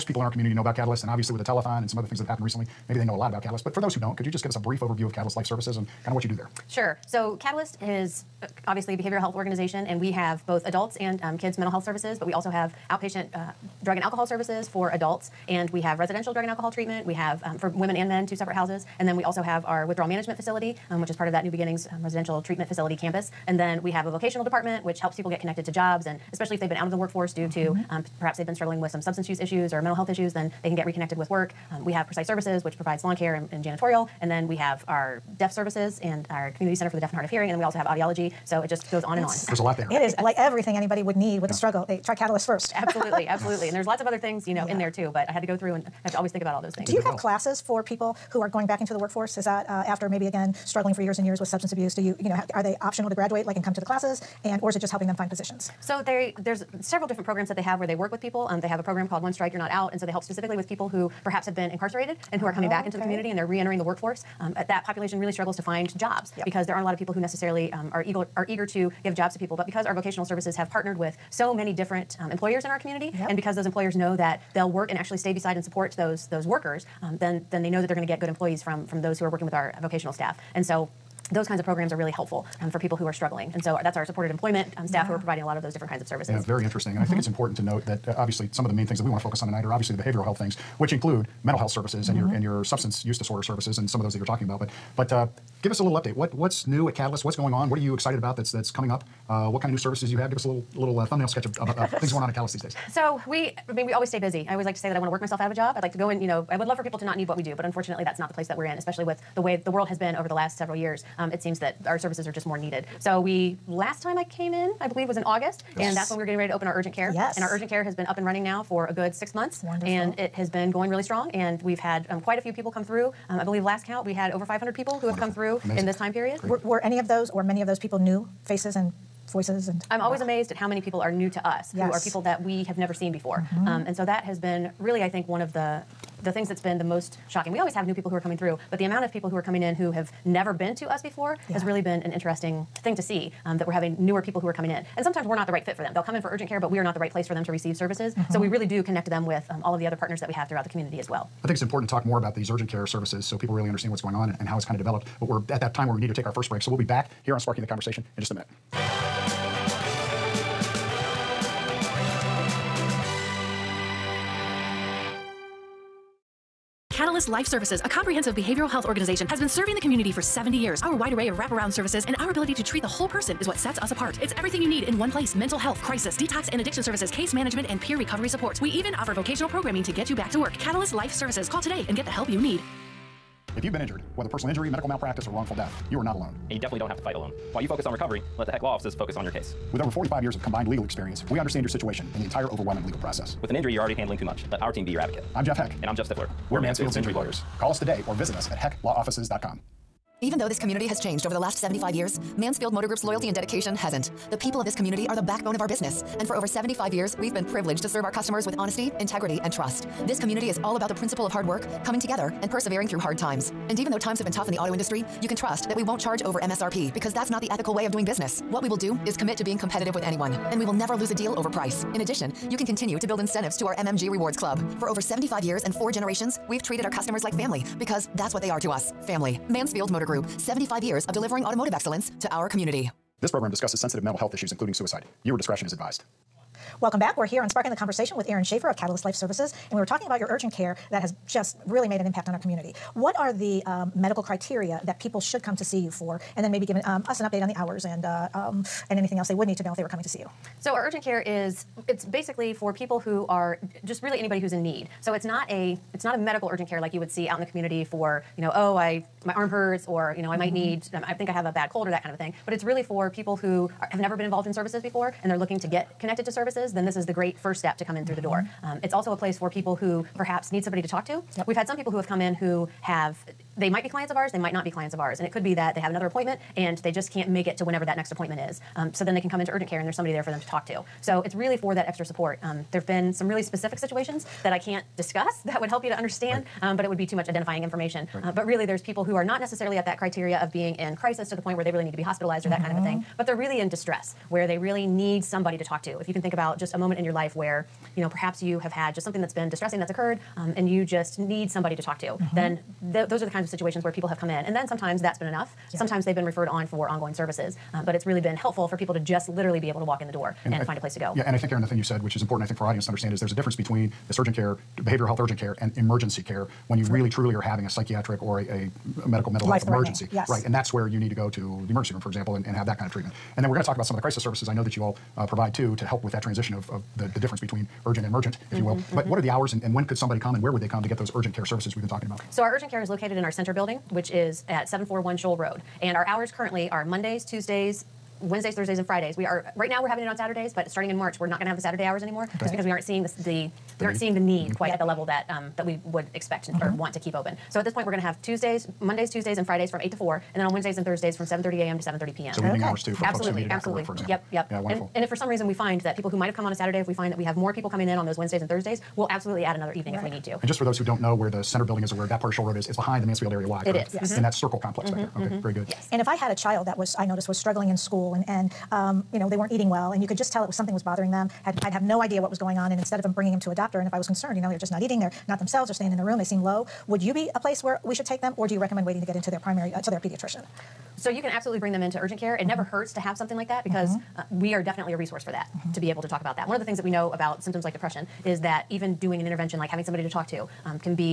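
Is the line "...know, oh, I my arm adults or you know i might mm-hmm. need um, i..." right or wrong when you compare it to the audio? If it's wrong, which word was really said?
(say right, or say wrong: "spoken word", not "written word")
wrong: "hurts", not "adults".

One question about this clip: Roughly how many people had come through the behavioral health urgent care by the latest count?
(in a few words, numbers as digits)
over 500.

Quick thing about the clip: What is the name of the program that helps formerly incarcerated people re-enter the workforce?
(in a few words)
One Strike You're Not Out.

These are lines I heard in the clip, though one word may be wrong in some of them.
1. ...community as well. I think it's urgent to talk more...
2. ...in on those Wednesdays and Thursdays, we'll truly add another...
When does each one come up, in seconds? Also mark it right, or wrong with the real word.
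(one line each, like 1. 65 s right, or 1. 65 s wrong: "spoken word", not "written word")
1. 150 s wrong: "important", not "urgent"
2. 357 s wrong: "absolutely", not "truly".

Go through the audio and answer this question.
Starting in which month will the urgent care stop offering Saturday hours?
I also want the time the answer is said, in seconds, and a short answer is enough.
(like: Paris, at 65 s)
March, at 340 s.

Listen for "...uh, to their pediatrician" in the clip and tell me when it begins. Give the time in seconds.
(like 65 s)
379 s.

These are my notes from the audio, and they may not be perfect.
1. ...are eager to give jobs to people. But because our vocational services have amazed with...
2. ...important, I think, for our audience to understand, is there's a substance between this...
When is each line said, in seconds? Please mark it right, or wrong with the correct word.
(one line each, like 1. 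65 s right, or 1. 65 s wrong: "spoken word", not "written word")
1. 68 s wrong: "partnered", not "amazed"
2. 312 s wrong: "difference", not "substance".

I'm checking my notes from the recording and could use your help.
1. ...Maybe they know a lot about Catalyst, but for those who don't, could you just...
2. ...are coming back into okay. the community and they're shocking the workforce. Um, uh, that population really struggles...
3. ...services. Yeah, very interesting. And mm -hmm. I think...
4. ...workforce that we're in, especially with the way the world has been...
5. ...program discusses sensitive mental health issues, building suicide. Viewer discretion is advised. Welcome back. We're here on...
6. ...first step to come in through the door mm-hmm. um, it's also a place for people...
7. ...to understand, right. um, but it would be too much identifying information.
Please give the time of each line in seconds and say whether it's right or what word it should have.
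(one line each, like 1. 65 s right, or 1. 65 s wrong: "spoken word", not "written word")
1. 2 s right
2. 62 s wrong: "reentering", not "shocking"
3. 86 s right
4. 108 s wrong: "place", not "workforce"
5. 233 s wrong: "including", not "building"
6. 267 s right
7. 285 s right.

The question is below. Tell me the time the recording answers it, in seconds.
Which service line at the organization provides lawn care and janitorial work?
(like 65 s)
32 s.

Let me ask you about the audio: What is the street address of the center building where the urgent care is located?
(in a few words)
741 Scholl Road.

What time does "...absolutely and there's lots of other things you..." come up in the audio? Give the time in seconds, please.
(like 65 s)
43 s.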